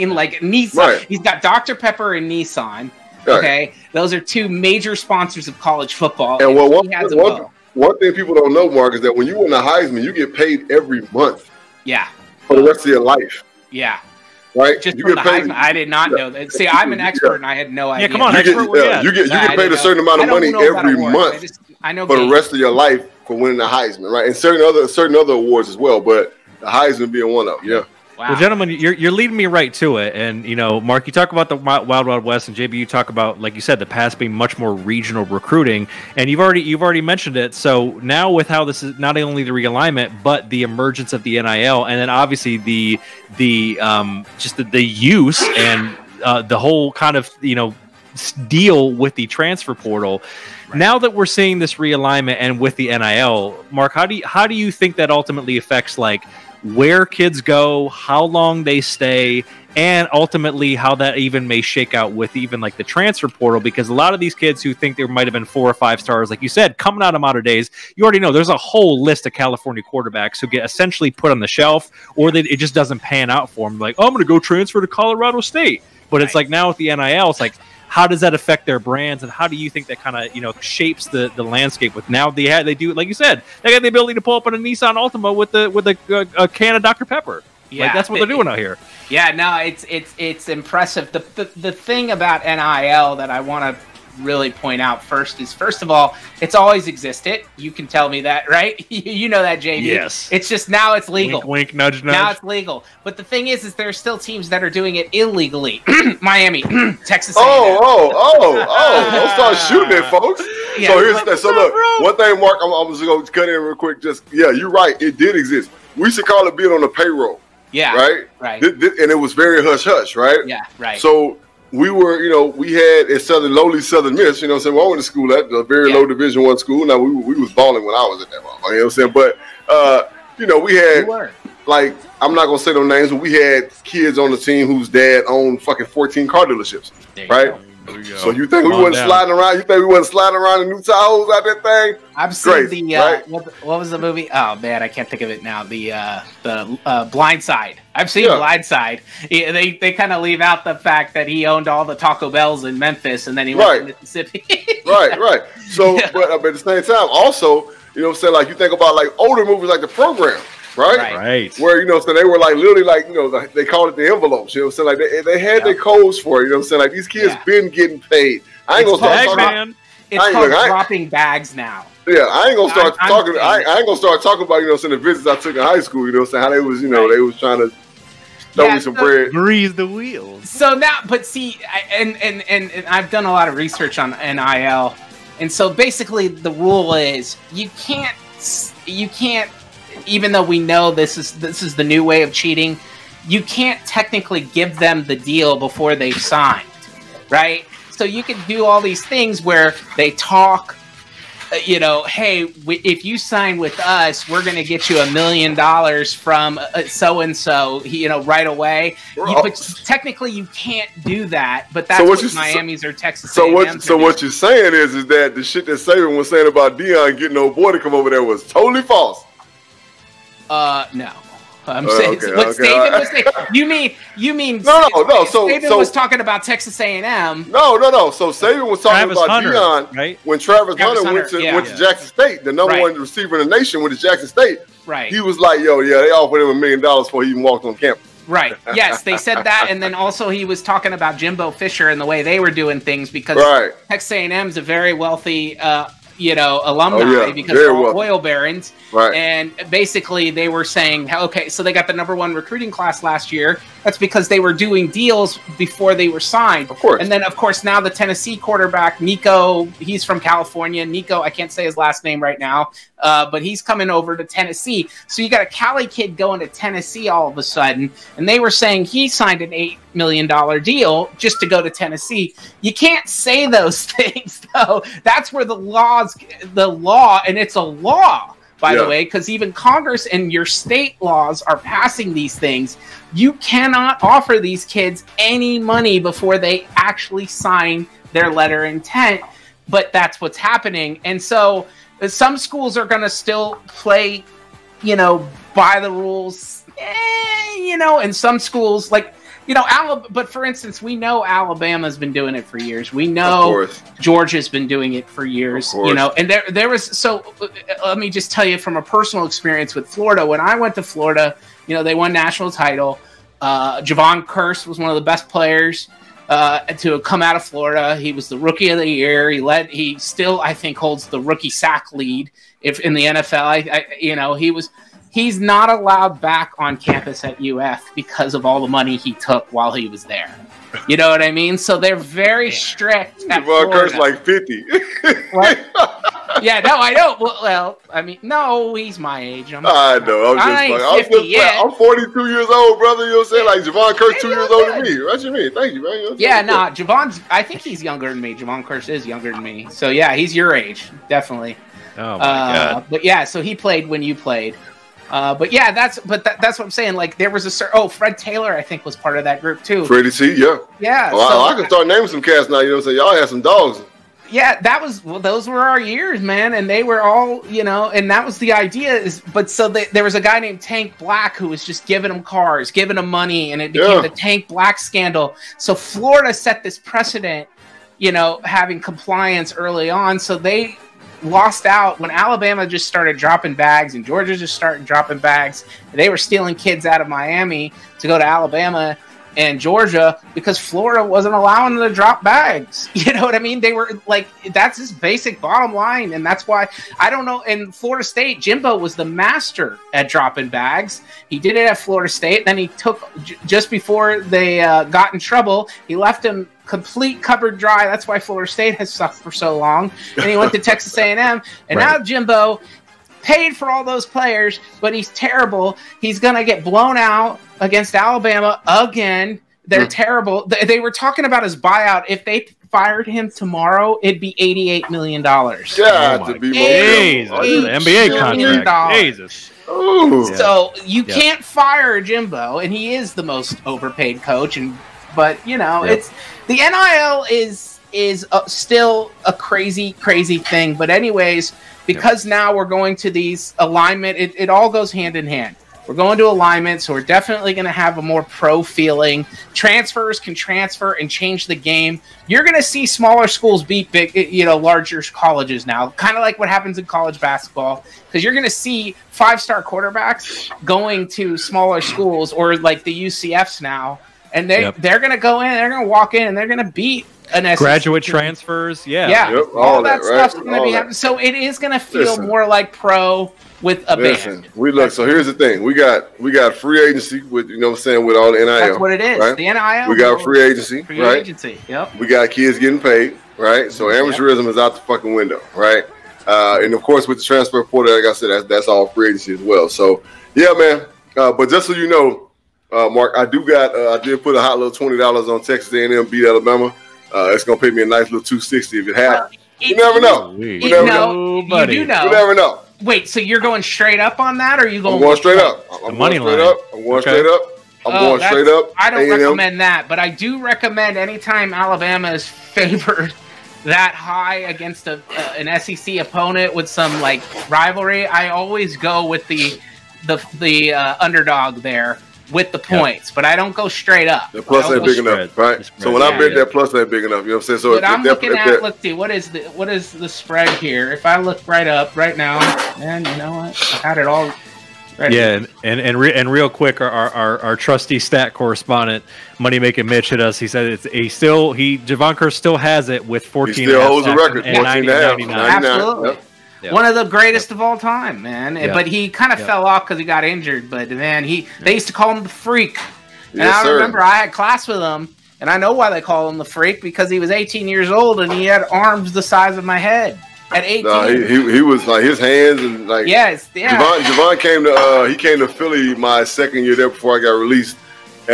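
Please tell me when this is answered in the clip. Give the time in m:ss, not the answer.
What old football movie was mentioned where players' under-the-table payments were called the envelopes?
2:39.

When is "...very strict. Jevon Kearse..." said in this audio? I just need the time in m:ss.
5:31.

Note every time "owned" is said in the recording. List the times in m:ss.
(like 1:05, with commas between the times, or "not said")
2:15, 2:31.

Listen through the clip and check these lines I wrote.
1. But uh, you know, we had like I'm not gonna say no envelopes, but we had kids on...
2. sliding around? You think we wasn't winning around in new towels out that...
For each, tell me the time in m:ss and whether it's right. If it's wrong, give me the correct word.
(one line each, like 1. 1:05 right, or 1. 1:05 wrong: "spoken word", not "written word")
1. 2:09 wrong: "names", not "envelopes"
2. 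2:19 wrong: "sliding", not "winning".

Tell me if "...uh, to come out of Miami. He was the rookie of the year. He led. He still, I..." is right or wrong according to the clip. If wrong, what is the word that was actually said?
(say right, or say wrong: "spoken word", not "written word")
wrong: "Florida", not "Miami".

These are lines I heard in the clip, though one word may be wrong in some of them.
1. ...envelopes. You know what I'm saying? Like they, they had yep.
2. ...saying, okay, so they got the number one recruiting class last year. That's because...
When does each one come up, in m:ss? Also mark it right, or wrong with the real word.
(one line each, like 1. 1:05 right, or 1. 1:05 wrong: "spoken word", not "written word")
1. 2:44 right
2. 4:10 right.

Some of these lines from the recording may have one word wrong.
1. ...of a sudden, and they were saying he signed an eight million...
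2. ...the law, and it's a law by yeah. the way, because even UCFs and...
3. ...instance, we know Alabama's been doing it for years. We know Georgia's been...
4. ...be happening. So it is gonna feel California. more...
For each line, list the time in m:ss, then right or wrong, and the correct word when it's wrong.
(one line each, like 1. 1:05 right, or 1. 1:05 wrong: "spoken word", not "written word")
1. 4:27 right
2. 4:36 wrong: "Congress", not "UCFs"
3. 5:00 right
4. 7:50 wrong: "Listen", not "California".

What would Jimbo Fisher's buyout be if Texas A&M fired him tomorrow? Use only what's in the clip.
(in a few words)
$88 million.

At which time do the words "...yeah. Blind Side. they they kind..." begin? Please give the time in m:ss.
2:28.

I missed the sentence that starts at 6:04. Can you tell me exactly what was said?
Yeah, that was well, those were our years, man, and they were all you know, and that was the idea.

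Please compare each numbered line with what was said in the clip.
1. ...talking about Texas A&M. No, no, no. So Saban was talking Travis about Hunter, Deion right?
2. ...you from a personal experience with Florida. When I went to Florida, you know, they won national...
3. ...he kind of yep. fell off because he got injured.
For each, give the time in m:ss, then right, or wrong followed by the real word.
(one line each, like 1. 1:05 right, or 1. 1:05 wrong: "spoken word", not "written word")
1. 3:45 right
2. 5:08 right
3. 9:08 right.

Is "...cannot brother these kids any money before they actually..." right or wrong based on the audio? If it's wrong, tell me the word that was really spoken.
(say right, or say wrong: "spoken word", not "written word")
wrong: "offer", not "brother".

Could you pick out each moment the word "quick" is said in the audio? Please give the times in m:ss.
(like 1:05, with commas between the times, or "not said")
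1:53, 8:56.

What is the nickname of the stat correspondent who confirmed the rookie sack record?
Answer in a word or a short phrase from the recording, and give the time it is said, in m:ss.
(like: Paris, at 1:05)
Money Making Mitch, at 8:59.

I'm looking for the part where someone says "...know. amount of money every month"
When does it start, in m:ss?
0:20.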